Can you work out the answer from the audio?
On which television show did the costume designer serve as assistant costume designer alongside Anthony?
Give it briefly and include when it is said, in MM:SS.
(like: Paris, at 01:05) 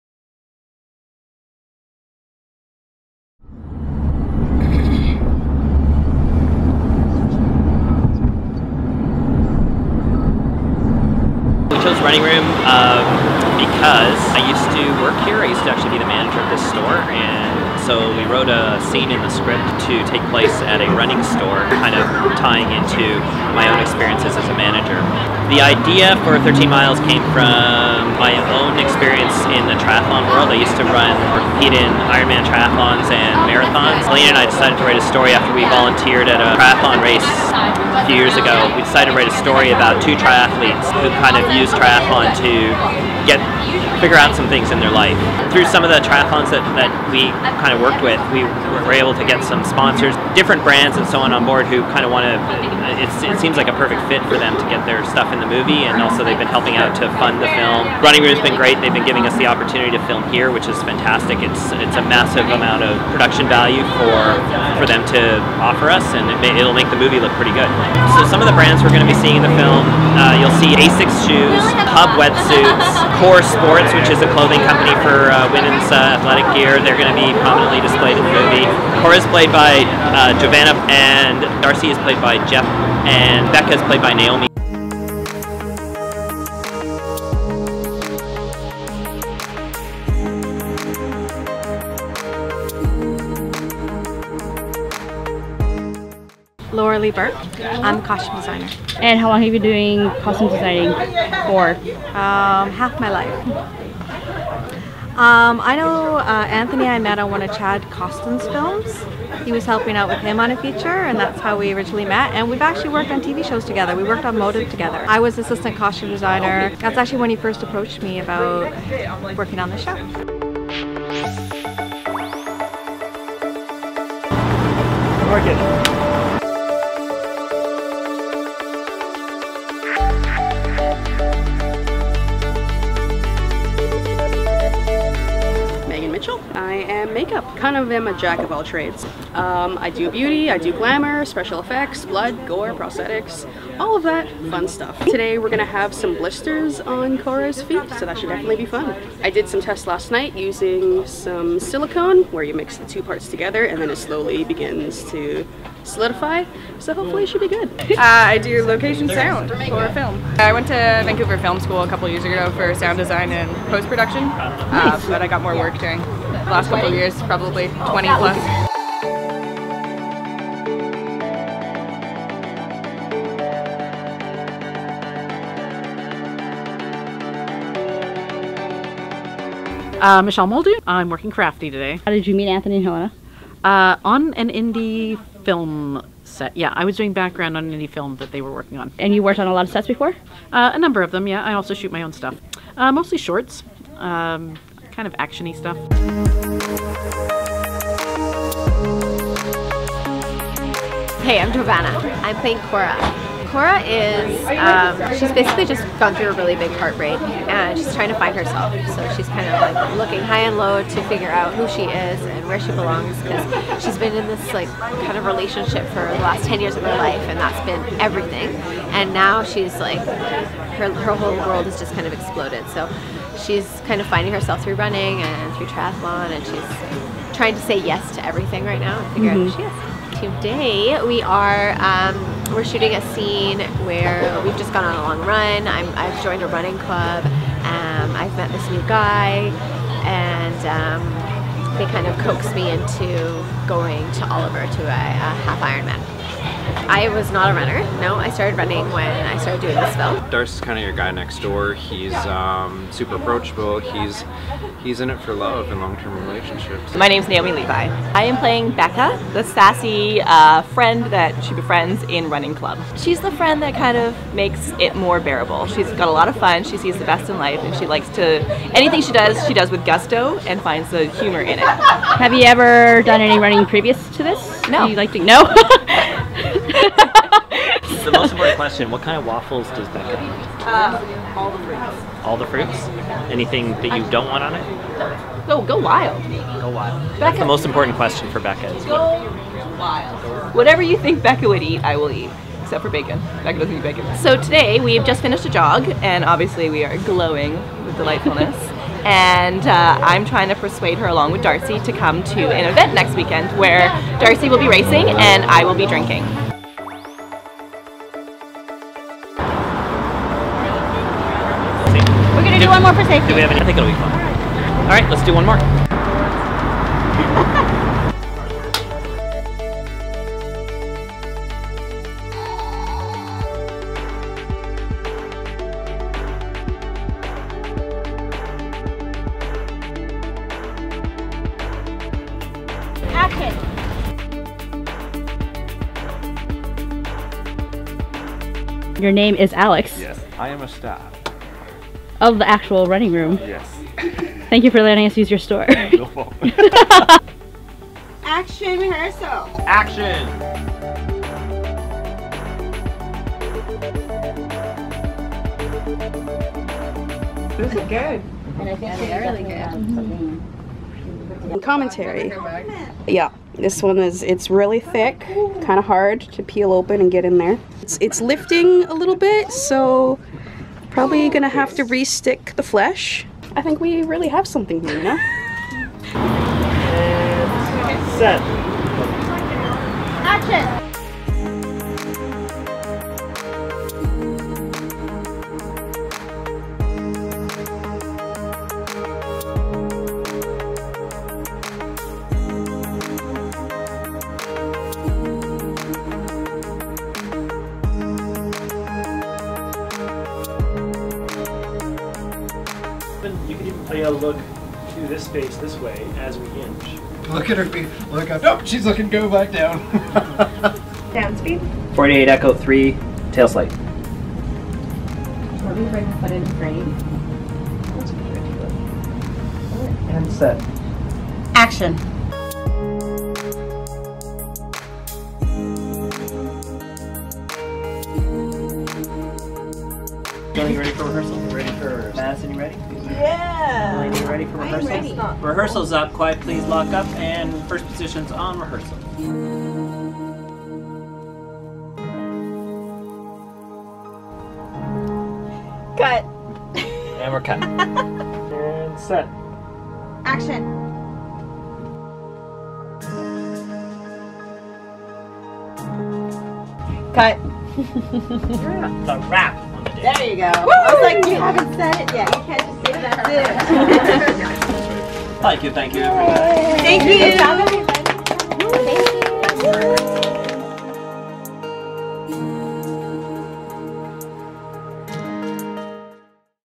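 Motive, at 01:54.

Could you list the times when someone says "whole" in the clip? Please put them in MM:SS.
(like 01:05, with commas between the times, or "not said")
03:41.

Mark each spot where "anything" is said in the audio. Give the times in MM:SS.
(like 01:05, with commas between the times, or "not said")
04:28, 04:43.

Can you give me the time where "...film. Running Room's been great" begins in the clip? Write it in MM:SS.
00:57.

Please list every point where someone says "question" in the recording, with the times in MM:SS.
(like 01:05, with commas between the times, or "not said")
04:38, 04:47.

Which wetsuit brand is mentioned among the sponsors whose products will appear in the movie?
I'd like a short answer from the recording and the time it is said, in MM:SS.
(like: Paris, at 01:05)
Huub, at 01:11.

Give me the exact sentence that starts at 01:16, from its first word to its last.
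They're going to be prominently displayed in the movie.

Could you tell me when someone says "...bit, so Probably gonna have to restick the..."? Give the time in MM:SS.
06:09.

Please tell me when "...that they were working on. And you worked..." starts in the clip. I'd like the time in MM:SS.
03:08.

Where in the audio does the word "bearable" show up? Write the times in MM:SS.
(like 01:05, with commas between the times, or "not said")
04:25.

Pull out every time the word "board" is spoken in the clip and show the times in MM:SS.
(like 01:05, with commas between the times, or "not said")
00:51.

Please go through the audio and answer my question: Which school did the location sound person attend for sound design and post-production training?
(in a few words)
Vancouver Film School.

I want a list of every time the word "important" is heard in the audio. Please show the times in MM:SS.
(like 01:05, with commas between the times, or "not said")
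04:38, 04:47.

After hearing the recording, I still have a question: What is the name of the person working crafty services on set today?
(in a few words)
Michelle Muldoon.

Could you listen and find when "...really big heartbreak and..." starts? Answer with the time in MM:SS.
03:26.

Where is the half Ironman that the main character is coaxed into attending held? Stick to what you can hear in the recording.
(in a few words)
Oliver.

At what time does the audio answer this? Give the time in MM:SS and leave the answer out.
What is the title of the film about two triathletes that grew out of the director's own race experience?
00:26.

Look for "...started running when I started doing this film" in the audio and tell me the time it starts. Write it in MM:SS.
04:08.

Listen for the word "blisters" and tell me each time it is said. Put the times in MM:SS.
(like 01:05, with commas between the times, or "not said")
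02:26.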